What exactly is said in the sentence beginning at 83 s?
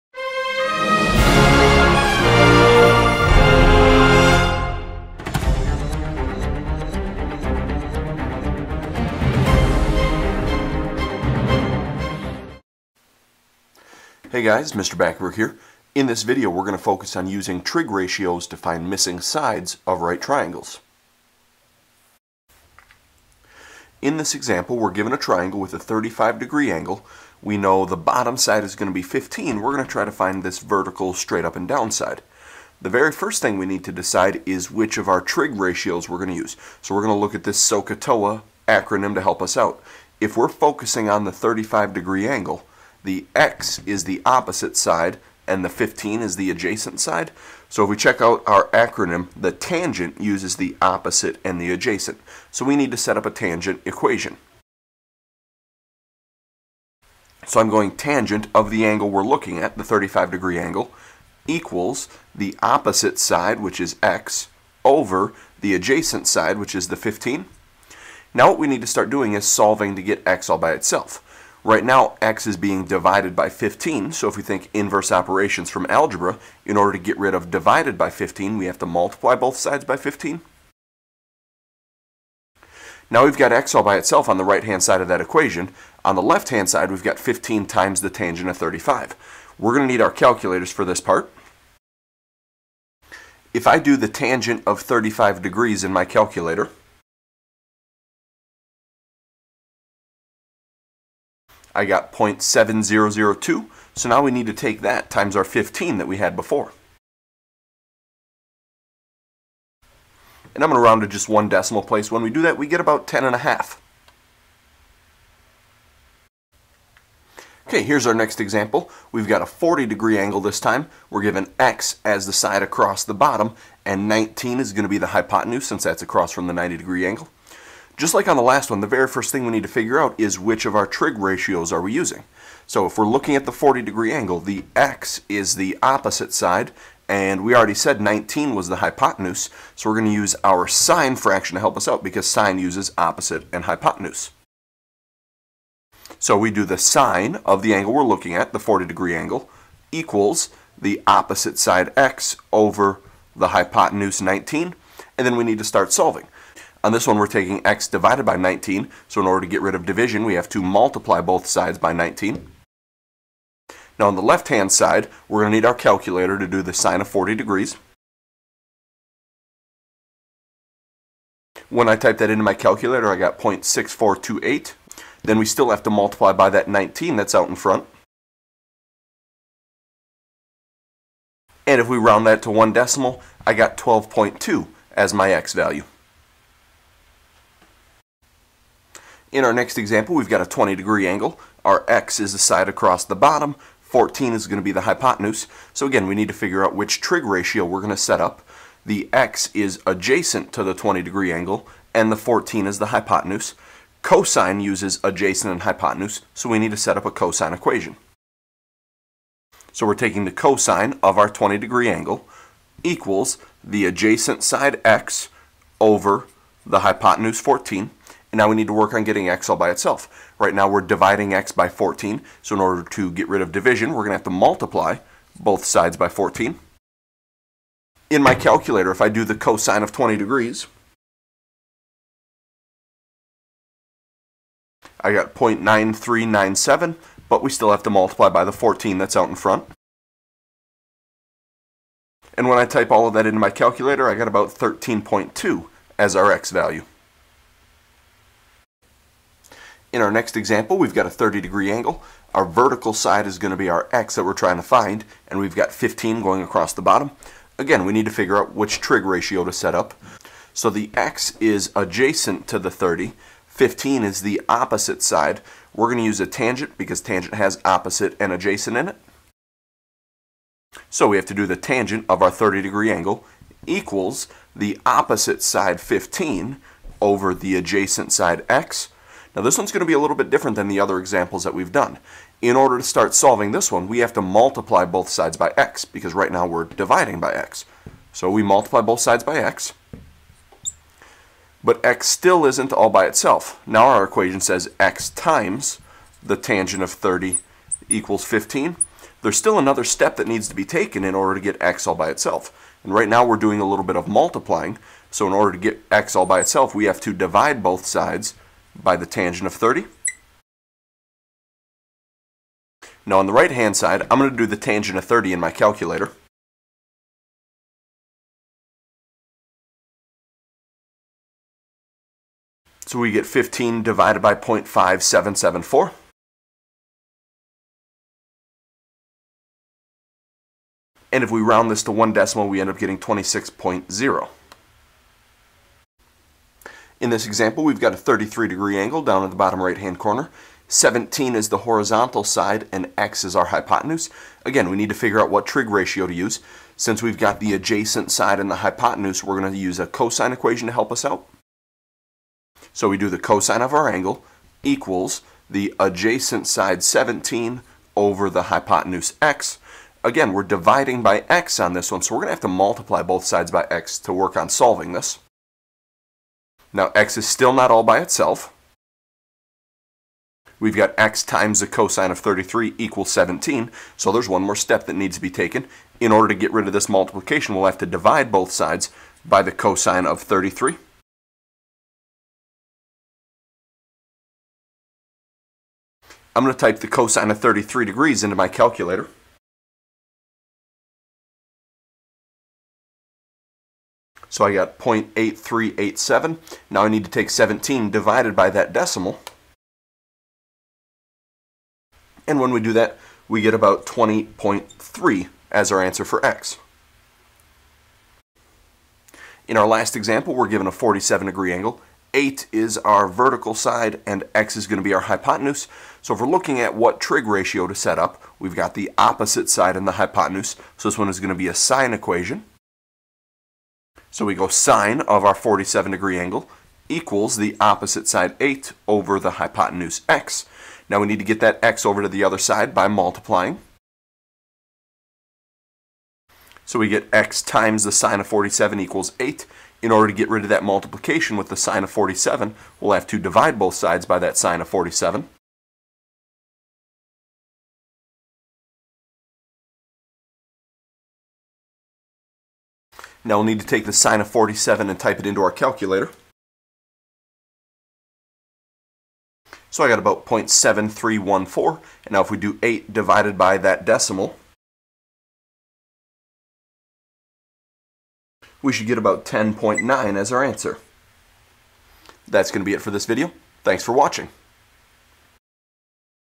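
Now we've got x all by itself on the right-hand side of that equation.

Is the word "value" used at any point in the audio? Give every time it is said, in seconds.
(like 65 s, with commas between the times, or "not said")
185 s, 246 s.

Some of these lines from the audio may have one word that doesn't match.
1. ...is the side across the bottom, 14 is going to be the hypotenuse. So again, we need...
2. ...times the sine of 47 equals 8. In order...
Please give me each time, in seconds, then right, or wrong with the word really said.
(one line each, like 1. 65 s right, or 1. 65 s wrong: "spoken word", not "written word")
1. 192 s right
2. 437 s right.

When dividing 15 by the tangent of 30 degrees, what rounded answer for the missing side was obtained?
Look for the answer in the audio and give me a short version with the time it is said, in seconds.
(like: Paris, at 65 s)
26.0, at 332 s.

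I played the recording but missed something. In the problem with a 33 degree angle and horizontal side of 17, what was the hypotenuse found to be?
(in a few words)
20.3.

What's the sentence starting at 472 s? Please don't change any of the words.
That's going to be it for this video.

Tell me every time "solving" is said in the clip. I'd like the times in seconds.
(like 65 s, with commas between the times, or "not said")
69 s, 155 s, 283 s, 364 s.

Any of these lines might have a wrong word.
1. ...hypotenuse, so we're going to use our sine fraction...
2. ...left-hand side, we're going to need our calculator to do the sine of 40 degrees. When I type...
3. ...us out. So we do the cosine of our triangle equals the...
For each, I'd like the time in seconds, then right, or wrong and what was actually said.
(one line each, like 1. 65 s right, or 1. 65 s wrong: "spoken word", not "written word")
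1. 138 s right
2. 164 s right
3. 350 s wrong: "angle", not "triangle".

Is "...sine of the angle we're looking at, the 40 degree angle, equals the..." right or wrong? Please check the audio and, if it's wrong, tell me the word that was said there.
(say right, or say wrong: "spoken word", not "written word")
right.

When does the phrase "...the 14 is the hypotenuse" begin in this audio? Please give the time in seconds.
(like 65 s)
202 s.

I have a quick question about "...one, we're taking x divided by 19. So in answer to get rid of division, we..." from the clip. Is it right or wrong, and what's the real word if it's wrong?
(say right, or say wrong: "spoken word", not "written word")
wrong: "order", not "answer".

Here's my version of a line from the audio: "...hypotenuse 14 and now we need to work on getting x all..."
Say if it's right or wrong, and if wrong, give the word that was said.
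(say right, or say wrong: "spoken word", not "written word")
right.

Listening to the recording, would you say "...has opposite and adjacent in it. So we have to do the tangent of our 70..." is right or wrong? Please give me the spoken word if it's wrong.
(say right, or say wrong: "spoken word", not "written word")
wrong: "30", not "70".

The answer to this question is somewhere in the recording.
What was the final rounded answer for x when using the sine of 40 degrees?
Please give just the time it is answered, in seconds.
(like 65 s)
183 s.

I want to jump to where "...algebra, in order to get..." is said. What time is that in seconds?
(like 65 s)
75 s.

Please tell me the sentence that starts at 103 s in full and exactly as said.
So now we need to take that times our 15 that we had before.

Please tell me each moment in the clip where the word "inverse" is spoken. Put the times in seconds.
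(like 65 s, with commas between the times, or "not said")
74 s.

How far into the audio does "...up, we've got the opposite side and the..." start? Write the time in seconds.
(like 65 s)
417 s.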